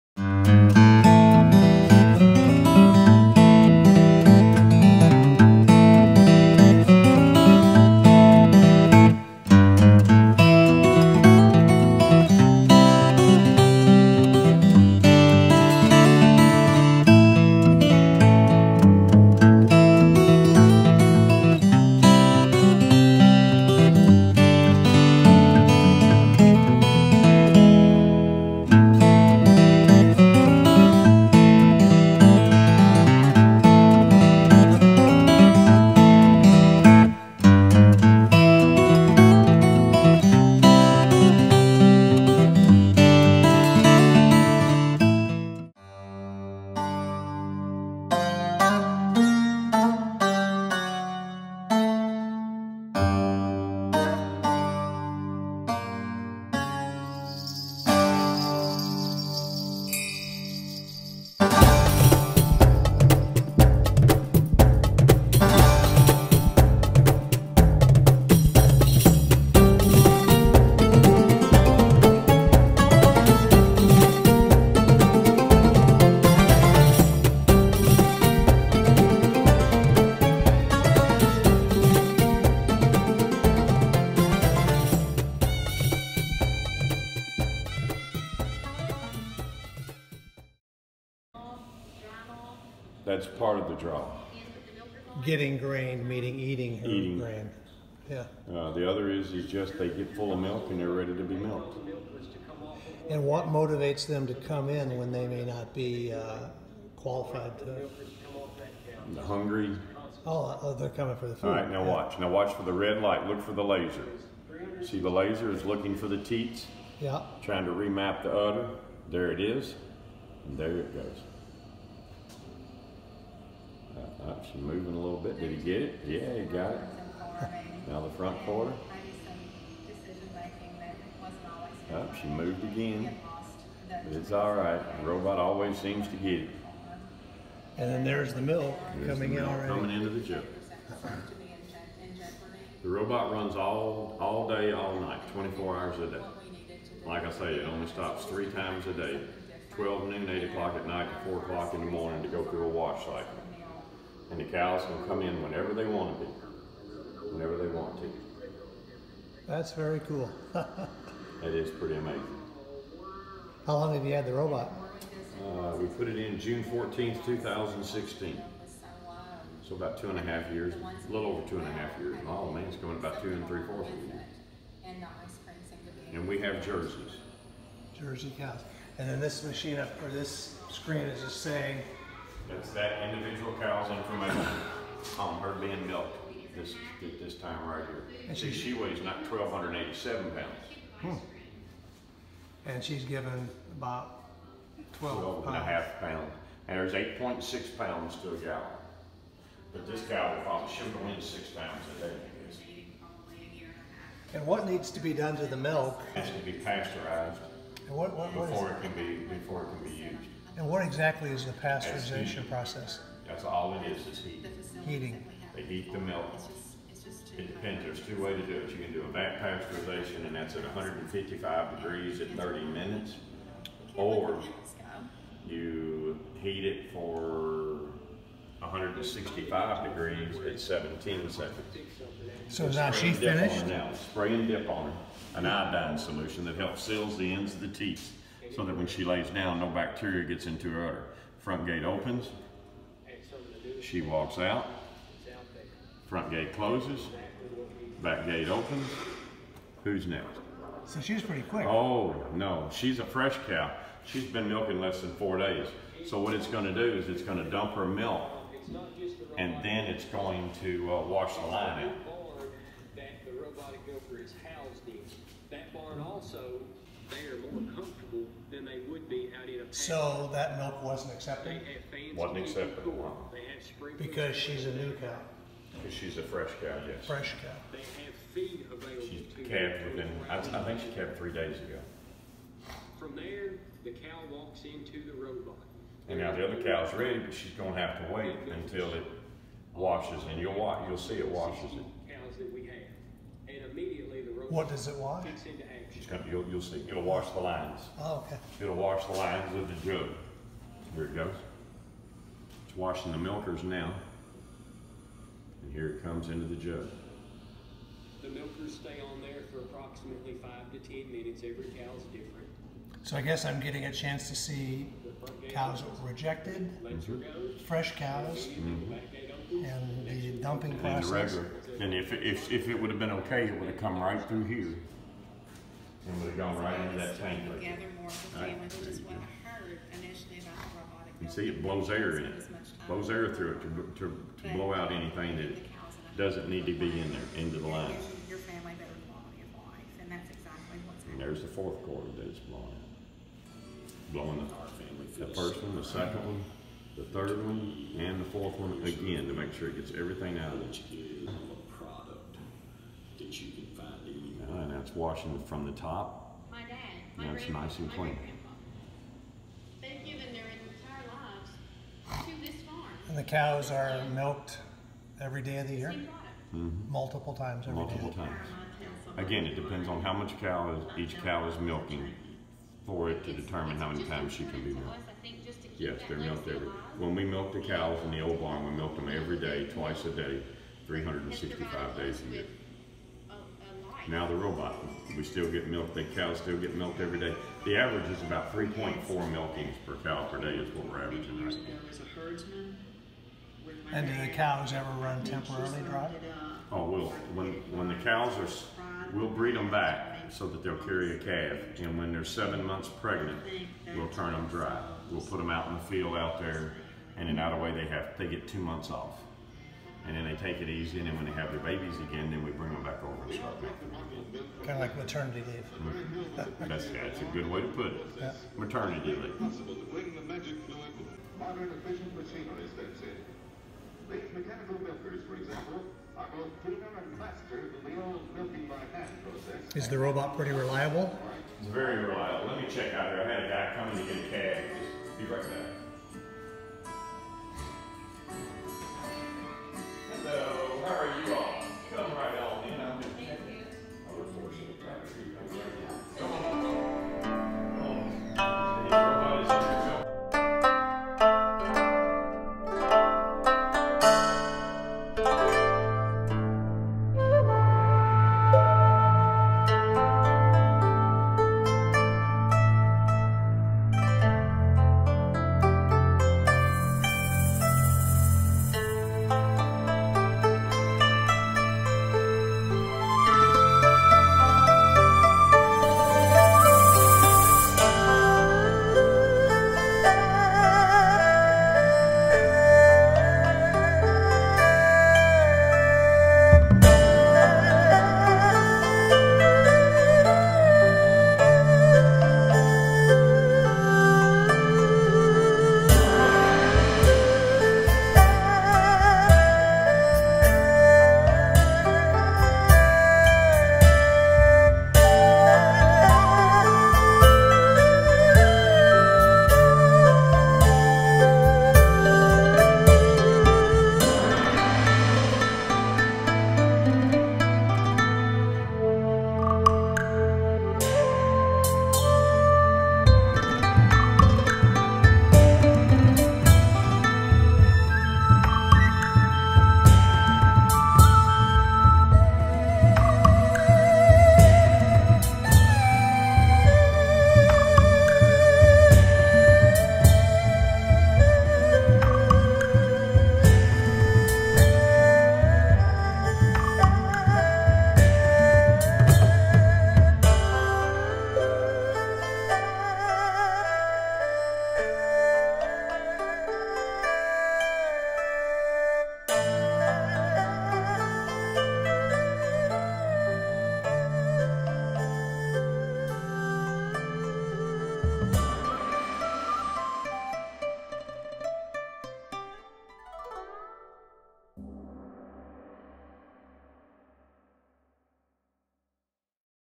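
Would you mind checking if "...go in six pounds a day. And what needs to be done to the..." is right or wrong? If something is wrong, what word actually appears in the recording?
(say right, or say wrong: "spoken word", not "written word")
right.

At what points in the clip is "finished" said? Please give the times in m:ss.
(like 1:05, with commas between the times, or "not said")
3:53.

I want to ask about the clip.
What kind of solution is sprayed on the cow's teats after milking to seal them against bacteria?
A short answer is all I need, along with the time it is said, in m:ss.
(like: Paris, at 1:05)
iodine solution, at 3:55.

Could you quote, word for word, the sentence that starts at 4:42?
From there, the cow walks into the robot.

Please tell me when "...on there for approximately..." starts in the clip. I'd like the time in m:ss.
5:09.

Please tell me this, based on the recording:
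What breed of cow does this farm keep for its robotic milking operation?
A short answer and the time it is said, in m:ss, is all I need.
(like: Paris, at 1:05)
Jersey, at 2:57.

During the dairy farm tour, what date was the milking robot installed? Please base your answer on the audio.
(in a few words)
June 14th, 2016.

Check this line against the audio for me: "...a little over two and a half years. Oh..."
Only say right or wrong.
right.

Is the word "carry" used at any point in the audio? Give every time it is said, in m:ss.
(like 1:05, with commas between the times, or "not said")
6:40.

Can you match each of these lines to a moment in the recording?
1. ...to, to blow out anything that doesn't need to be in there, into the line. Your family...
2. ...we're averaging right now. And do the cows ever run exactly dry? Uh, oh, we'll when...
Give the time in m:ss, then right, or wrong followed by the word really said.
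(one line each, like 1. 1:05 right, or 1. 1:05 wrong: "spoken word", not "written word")
1. 5:33 right
2. 6:30 wrong: "temporarily", not "exactly".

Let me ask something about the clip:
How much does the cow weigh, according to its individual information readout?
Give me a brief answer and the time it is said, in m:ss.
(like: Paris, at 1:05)
1,287 pounds, at 3:09.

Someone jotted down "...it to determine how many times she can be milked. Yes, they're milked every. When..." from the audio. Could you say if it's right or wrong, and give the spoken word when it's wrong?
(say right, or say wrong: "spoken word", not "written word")
right.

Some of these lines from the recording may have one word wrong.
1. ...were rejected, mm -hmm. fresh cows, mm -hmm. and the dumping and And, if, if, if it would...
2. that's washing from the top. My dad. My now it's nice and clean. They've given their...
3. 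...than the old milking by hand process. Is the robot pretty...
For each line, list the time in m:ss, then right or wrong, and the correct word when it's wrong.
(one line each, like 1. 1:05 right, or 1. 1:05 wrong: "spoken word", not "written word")
1. 5:16 right
2. 5:54 right
3. 7:07 right.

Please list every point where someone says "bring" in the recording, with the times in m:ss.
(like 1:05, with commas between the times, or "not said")
6:52.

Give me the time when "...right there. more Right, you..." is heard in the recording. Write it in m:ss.
5:27.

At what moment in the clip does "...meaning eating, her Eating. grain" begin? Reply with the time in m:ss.
1:36.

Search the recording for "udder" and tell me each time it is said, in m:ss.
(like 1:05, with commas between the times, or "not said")
1:58, 4:00.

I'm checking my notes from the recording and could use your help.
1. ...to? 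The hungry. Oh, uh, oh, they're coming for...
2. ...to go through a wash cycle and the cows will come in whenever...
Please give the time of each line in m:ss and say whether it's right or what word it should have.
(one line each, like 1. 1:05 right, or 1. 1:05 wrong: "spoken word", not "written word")
1. 1:47 right
2. 2:32 right.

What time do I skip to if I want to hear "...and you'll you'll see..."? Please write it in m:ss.
4:50.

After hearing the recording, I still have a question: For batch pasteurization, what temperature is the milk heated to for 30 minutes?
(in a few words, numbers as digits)
155 degrees.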